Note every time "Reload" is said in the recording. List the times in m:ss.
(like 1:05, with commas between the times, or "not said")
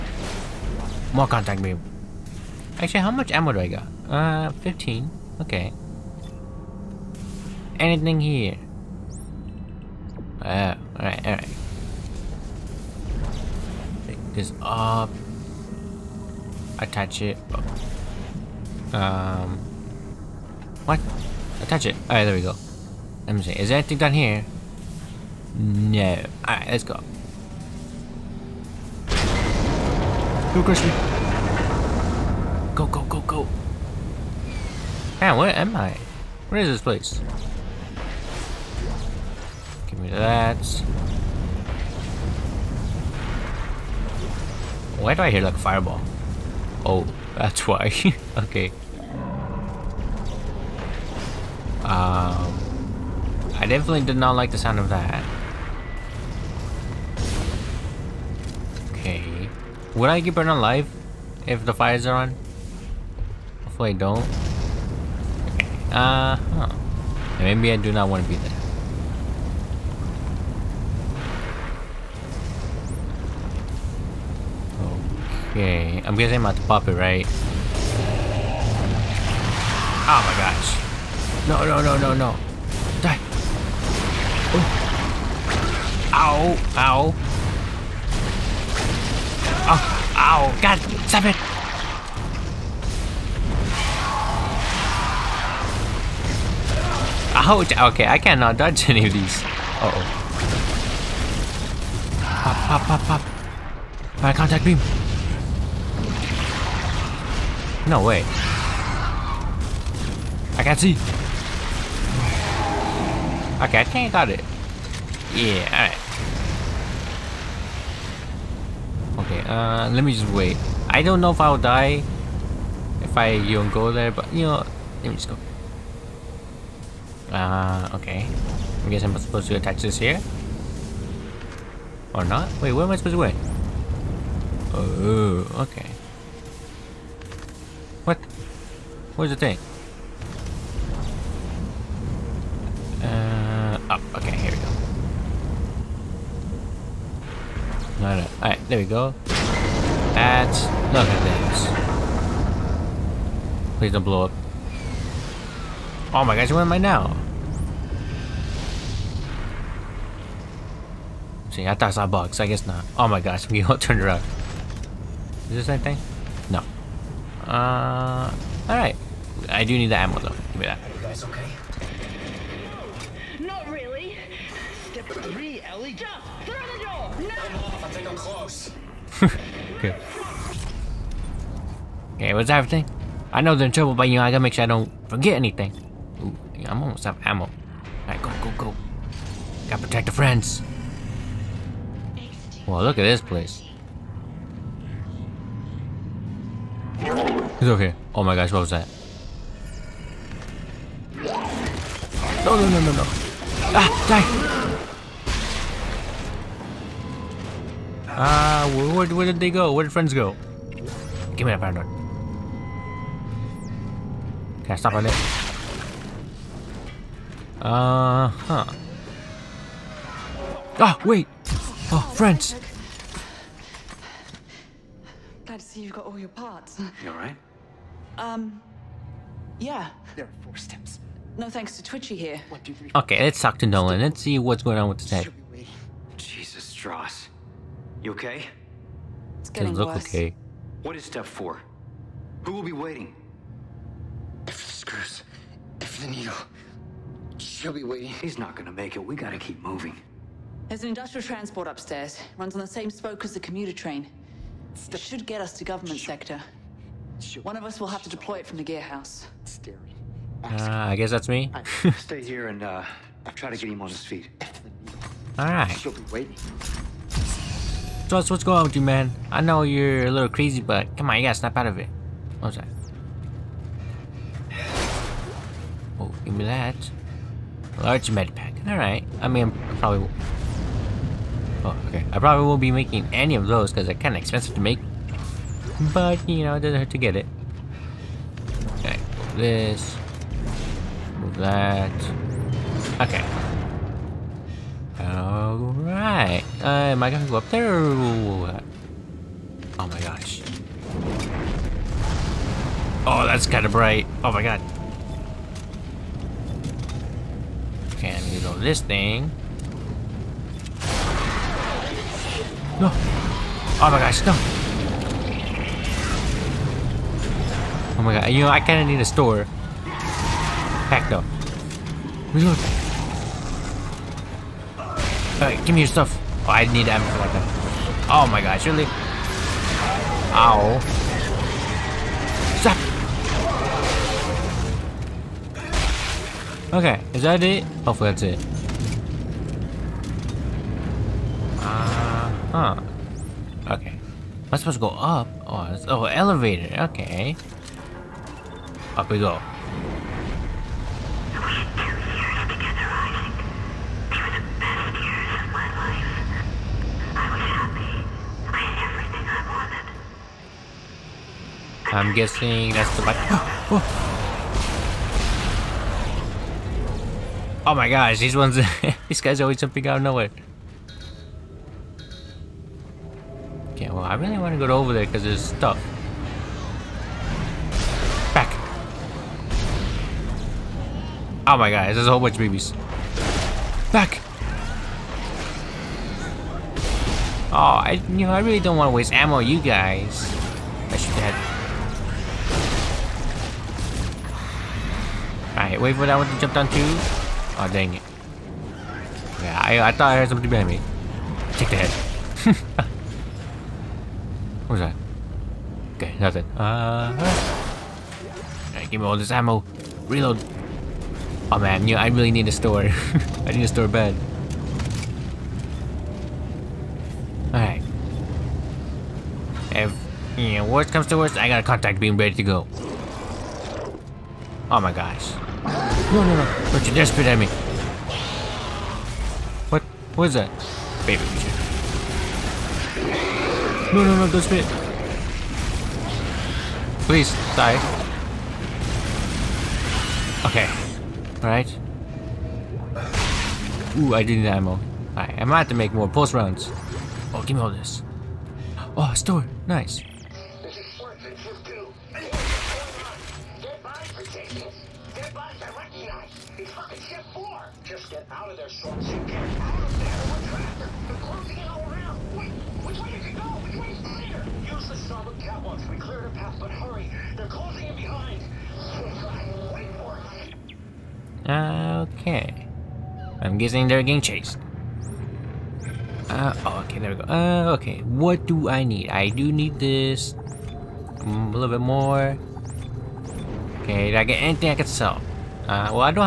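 5:22, 6:50.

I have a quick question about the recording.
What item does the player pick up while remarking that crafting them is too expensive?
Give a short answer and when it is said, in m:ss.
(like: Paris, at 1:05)
Large med pack, at 4:37.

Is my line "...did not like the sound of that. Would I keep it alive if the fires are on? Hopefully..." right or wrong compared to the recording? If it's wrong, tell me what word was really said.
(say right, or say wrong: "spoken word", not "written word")
right.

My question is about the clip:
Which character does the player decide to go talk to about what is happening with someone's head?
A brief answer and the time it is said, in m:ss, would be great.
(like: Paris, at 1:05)
Nolan, at 3:53.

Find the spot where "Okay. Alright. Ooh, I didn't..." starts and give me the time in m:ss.
7:20.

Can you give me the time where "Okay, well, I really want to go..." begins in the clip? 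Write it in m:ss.
6:13.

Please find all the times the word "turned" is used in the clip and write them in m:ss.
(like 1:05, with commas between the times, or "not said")
2:43.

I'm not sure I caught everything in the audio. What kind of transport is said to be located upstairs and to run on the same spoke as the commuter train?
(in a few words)
industrial transport.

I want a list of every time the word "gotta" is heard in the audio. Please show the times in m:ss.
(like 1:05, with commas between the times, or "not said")
3:04, 3:09, 4:09, 4:31.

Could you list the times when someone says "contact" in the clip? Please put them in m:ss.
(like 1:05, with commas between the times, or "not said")
0:01, 1:44, 7:01.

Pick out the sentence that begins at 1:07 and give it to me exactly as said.
Maybe I do not want to be there.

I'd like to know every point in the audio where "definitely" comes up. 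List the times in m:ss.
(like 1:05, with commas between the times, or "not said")
0:53.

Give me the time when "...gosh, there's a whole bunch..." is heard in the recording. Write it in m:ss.
6:21.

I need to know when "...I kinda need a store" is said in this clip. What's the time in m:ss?
5:18.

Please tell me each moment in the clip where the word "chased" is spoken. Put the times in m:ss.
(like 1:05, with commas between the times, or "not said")
7:54.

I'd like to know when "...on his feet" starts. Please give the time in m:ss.
4:23.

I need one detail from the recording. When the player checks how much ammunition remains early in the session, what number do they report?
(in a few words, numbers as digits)
15.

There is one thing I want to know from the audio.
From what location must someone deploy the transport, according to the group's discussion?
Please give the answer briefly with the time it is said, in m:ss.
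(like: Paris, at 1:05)
gear house, at 4:18.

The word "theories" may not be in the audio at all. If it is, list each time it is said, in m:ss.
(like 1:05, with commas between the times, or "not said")
not said.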